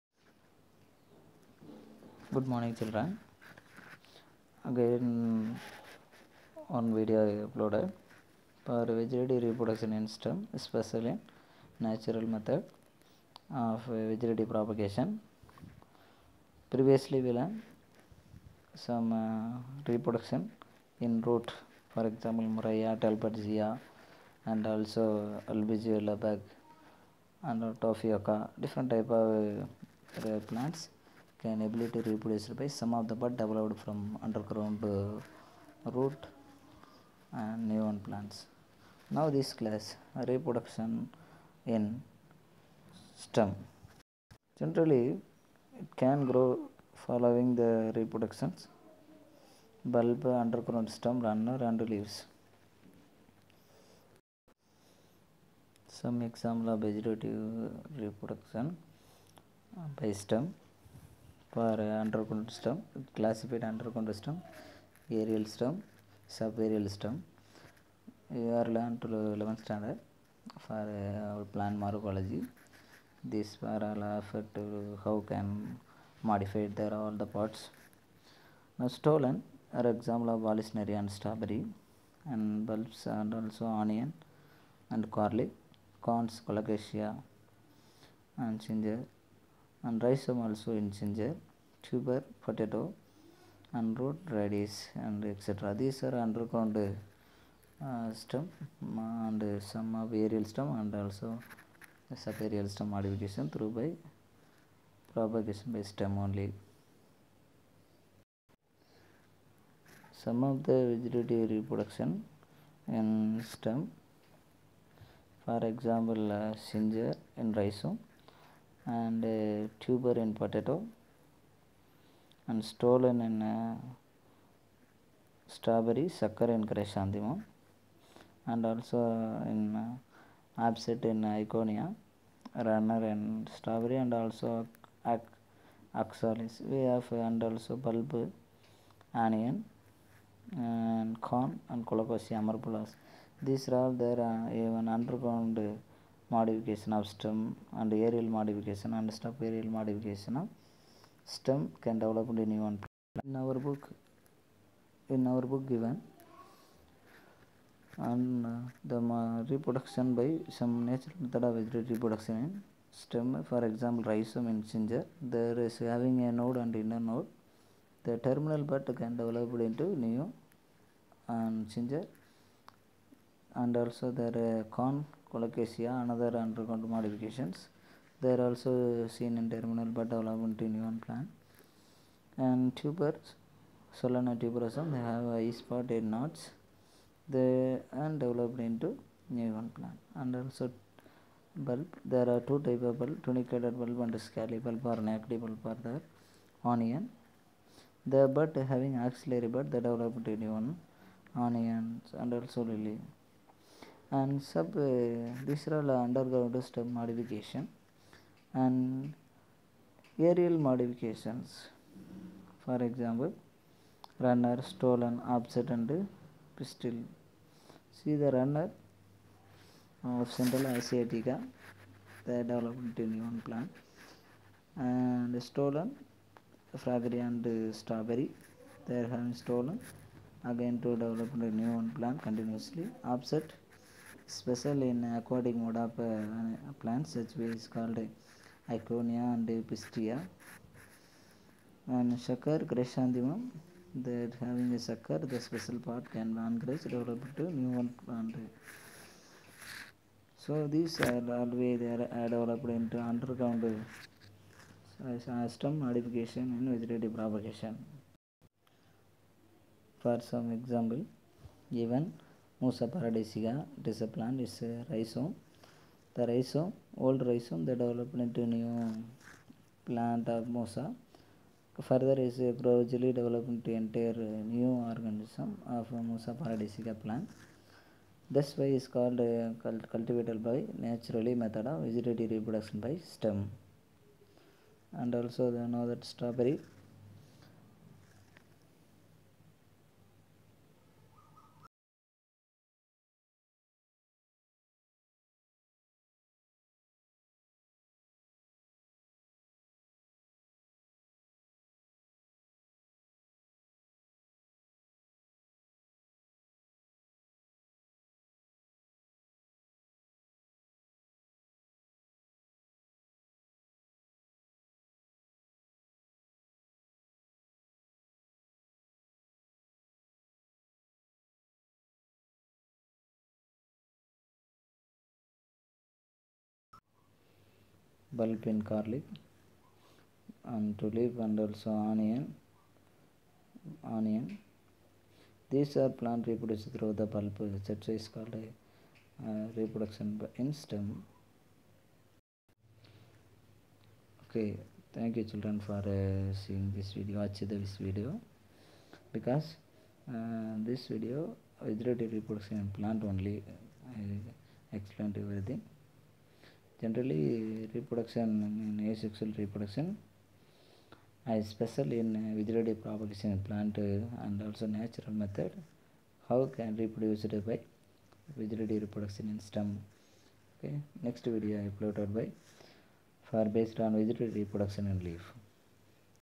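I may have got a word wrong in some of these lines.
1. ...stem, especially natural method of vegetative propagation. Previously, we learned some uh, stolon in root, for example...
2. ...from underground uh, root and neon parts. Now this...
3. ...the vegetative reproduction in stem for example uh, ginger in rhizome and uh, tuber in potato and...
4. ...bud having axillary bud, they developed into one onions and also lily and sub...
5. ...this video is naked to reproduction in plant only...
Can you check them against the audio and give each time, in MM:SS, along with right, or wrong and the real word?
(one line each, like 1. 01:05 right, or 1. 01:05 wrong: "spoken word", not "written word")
1. 00:10 wrong: "reproduction", not "stolon"
2. 00:33 wrong: "plants", not "parts"
3. 01:50 right
4. 03:18 right
5. 05:50 wrong: "related", not "naked".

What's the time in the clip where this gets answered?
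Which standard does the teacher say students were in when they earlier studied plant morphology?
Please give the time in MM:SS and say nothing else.
01:09.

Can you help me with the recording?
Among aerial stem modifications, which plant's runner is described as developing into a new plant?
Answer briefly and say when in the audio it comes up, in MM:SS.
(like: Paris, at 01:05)
Centella asiatica, at 03:40.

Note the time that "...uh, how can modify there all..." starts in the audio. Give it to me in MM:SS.
01:14.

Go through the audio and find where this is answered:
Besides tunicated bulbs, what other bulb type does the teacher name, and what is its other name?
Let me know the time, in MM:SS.
03:14.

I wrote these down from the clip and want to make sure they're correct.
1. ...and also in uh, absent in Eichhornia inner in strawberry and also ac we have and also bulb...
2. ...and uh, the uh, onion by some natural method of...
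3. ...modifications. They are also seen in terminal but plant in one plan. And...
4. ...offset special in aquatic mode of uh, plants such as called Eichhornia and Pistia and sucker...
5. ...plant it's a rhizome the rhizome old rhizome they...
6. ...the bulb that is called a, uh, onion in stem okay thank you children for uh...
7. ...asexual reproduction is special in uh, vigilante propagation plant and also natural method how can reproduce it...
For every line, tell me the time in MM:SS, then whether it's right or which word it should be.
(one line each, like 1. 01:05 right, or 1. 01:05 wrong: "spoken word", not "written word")
1. 02:08 wrong: "runner", not "inner"
2. 02:38 wrong: "reproduction", not "onion"
3. 02:56 wrong: "development", not "plant"
4. 03:53 right
5. 04:24 right
6. 05:36 wrong: "reproduction", not "onion"
7. 05:58 right.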